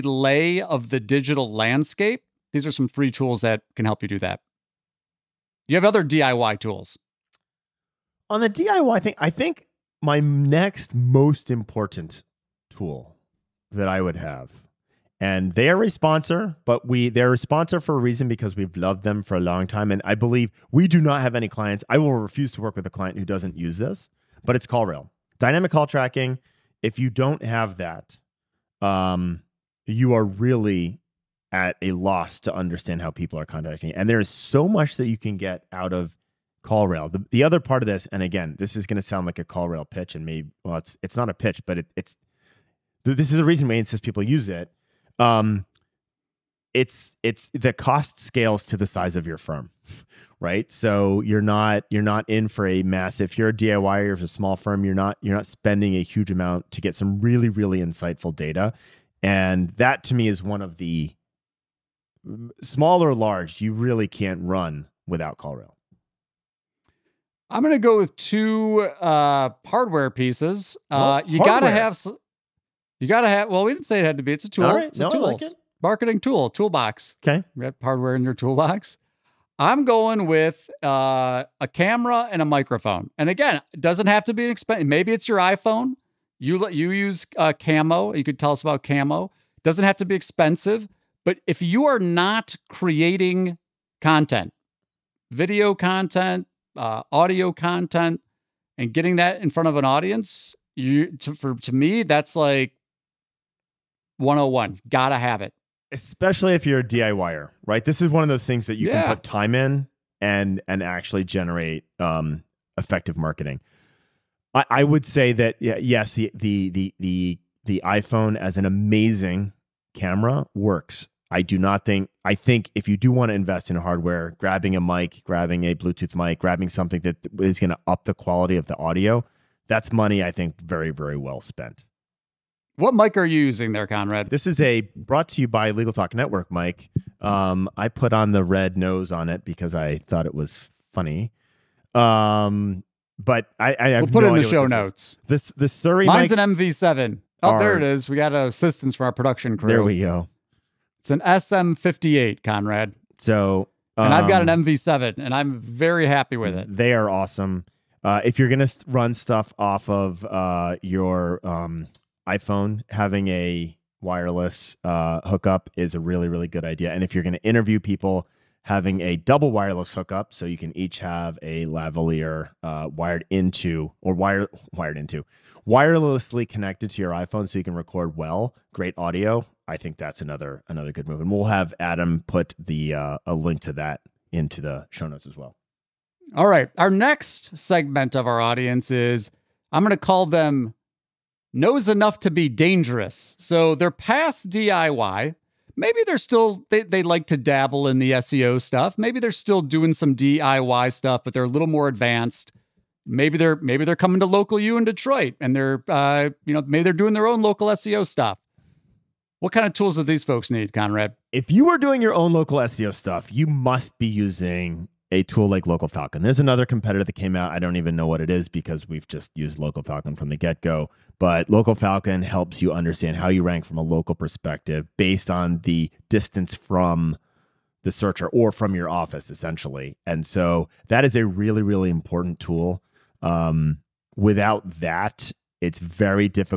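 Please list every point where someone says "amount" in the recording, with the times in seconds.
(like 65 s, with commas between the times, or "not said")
56 s.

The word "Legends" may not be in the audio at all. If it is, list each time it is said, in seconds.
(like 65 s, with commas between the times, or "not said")
not said.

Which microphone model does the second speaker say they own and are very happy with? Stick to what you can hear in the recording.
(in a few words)
MV7.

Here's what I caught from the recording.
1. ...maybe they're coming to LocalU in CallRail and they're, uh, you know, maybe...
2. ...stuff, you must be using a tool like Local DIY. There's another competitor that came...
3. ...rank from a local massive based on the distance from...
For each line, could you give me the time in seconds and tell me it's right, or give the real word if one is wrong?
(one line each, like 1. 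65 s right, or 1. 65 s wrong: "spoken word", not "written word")
1. 203 s wrong: "Detroit", not "CallRail"
2. 212 s wrong: "Falcon", not "DIY"
3. 223 s wrong: "perspective", not "massive".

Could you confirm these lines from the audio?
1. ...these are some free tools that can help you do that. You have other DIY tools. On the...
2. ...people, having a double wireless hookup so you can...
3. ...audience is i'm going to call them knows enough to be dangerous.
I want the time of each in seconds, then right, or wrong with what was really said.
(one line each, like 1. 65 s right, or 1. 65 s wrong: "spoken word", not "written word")
1. 2 s right
2. 167 s right
3. 188 s right.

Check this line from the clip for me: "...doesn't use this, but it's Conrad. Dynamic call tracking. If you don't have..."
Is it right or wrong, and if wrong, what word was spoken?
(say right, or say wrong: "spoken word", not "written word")
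wrong: "CallRail", not "Conrad".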